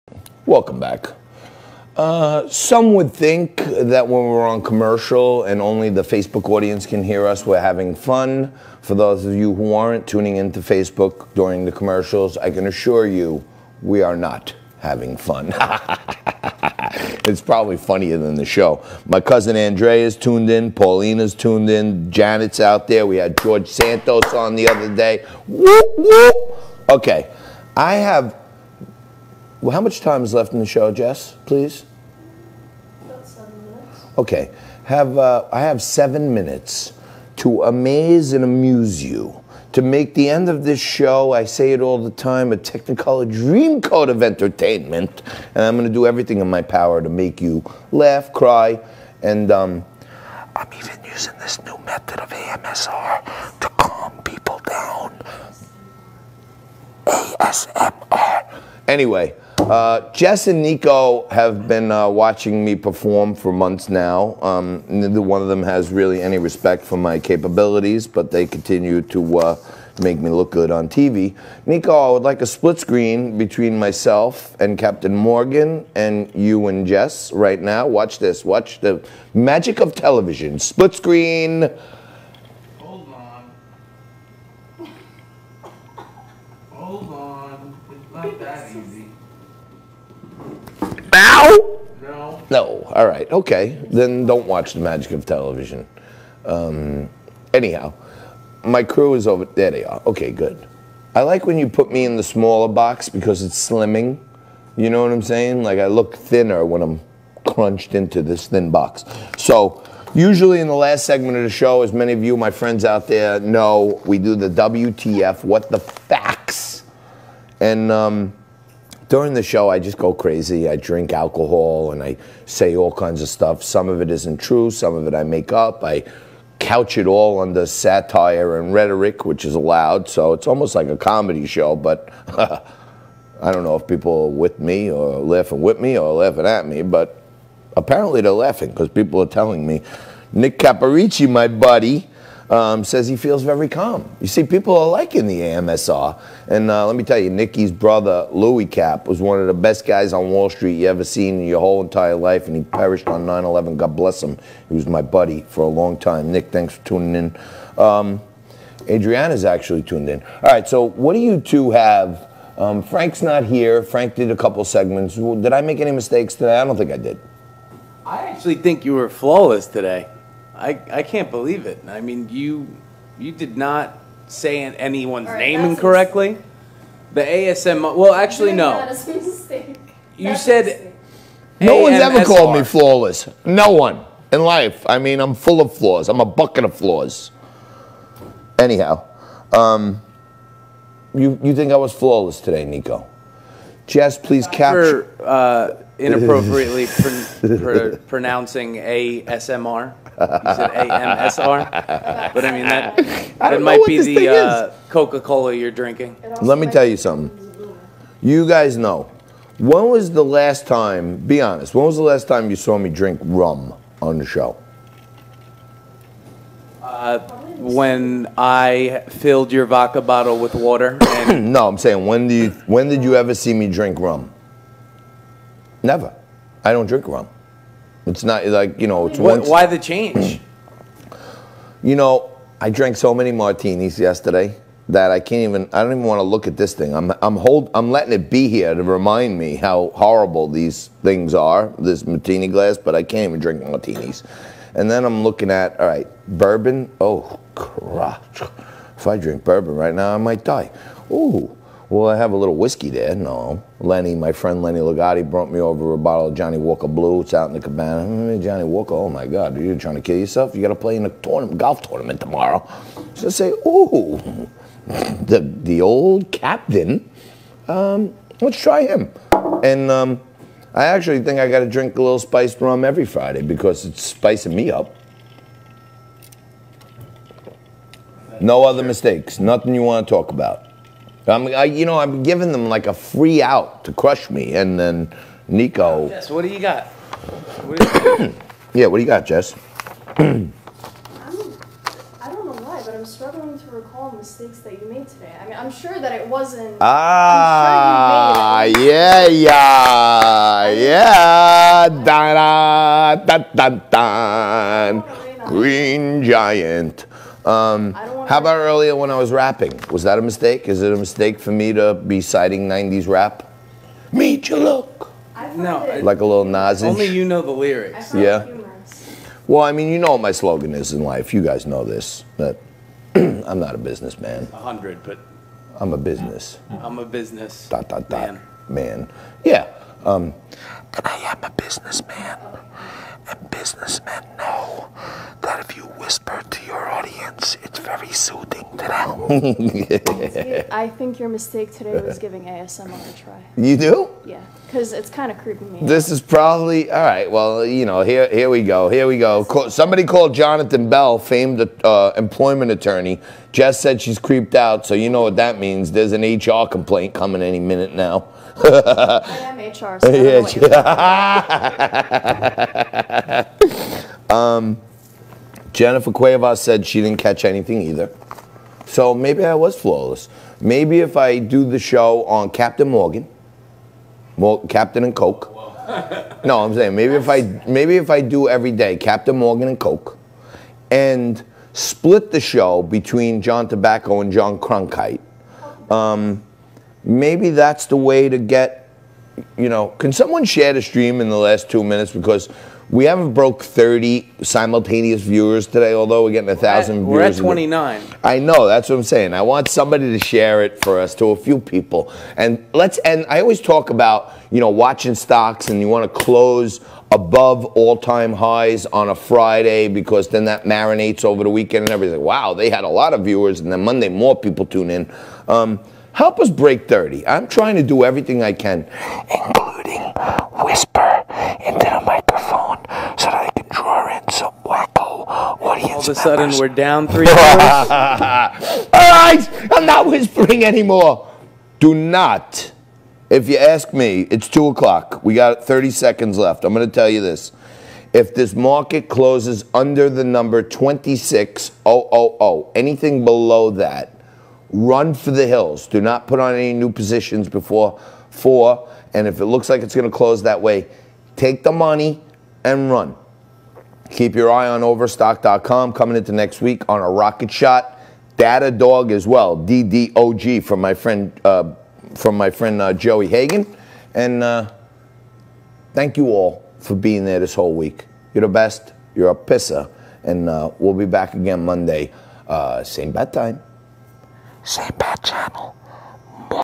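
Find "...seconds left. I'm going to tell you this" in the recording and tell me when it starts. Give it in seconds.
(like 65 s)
435 s.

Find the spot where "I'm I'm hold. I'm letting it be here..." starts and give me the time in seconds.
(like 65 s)
236 s.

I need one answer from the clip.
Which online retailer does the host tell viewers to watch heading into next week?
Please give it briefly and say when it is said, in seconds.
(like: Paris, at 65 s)
Overstock.com, at 454 s.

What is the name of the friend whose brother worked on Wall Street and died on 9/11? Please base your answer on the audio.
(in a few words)
Nick Caparici.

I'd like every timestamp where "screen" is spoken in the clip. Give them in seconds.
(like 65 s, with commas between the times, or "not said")
72 s, 80 s.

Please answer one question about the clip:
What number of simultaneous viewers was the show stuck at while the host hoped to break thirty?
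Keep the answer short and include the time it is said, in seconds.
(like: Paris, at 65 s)
29, at 397 s.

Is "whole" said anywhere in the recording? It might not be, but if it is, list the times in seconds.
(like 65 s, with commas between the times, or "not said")
151 s, 467 s.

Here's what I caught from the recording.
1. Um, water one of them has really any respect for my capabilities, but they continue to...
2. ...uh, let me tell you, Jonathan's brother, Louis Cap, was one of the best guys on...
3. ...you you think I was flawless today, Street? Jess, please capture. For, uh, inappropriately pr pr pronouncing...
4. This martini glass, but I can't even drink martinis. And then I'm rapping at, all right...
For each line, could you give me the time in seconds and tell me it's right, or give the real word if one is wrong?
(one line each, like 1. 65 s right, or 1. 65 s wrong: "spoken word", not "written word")
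1. 64 s wrong: "neither", not "water"
2. 146 s wrong: "Nicky", not "Jonathan"
3. 191 s wrong: "Nico", not "Street"
4. 241 s wrong: "looking", not "rapping".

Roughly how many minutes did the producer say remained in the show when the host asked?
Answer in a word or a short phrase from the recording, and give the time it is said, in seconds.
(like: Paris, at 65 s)
7, at 33 s.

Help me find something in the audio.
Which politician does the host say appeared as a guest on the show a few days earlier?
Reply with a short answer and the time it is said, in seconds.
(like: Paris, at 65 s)
George Santos, at 23 s.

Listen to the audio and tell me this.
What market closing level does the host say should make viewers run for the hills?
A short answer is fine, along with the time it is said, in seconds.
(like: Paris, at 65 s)
26000, at 440 s.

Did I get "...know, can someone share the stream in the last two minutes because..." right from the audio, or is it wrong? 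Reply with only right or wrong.
right.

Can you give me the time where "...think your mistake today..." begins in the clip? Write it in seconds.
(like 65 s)
340 s.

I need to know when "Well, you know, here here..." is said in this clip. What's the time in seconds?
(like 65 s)
347 s.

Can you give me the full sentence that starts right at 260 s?
You got to play in a tournament, golf tournament tomorrow.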